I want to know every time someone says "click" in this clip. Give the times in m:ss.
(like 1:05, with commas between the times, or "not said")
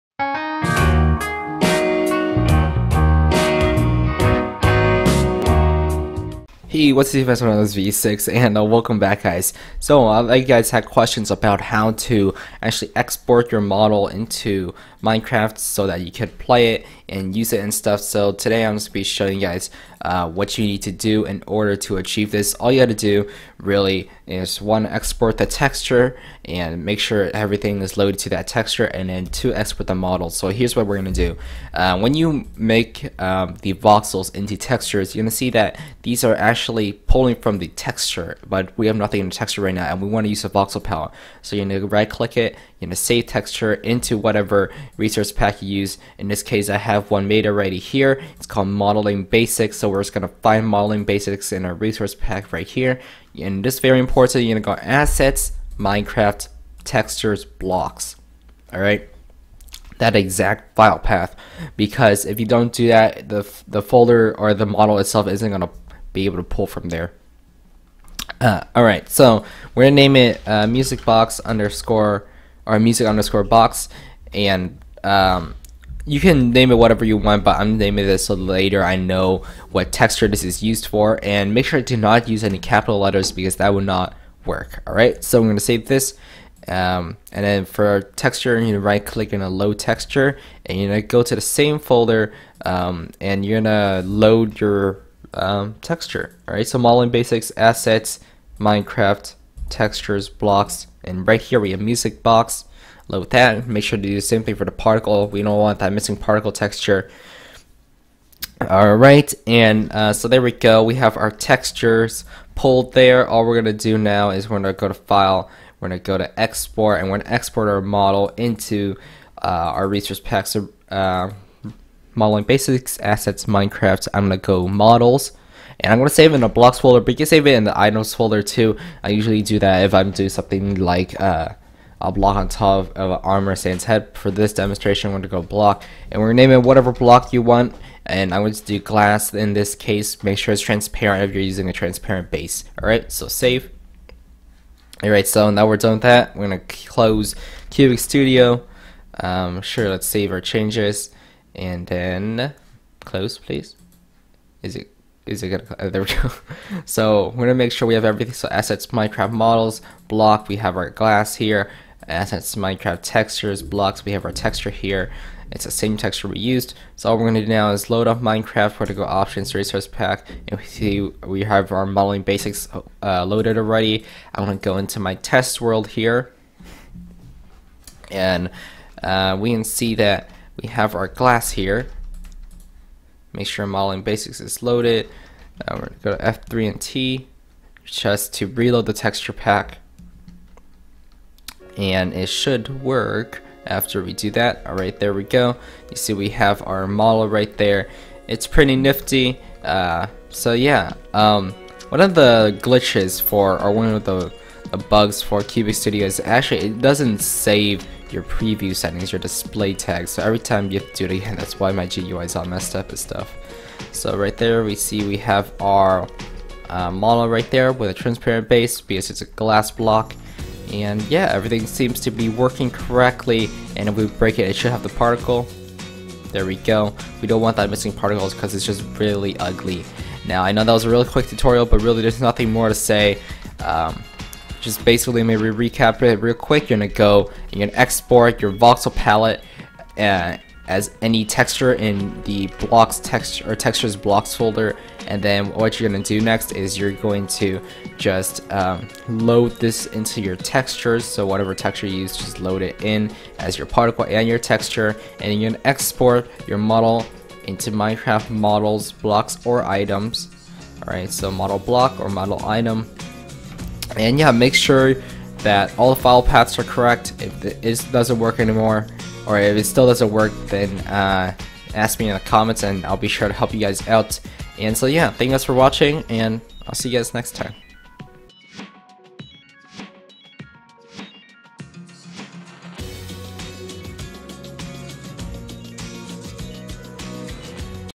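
0:42, 1:29.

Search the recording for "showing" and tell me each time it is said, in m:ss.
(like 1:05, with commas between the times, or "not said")
0:19.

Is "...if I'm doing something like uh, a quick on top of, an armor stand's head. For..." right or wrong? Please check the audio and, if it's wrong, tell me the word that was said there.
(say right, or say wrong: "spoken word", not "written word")
wrong: "block", not "quick".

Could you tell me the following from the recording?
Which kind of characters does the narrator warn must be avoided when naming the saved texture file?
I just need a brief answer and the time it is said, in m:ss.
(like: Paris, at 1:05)
capital letters, at 1:22.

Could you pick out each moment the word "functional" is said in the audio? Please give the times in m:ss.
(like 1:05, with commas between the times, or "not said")
not said.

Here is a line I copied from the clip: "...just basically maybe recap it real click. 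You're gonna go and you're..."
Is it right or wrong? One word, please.
wrong.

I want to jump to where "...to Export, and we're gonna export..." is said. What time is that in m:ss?
1:56.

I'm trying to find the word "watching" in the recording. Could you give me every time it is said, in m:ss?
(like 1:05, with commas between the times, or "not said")
4:35.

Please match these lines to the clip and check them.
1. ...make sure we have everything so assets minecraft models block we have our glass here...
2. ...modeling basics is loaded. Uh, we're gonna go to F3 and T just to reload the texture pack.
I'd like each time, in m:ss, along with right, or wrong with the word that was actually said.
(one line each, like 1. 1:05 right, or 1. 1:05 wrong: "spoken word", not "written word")
1. 2:37 right
2. 3:03 right.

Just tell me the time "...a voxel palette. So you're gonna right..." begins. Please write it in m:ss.
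0:40.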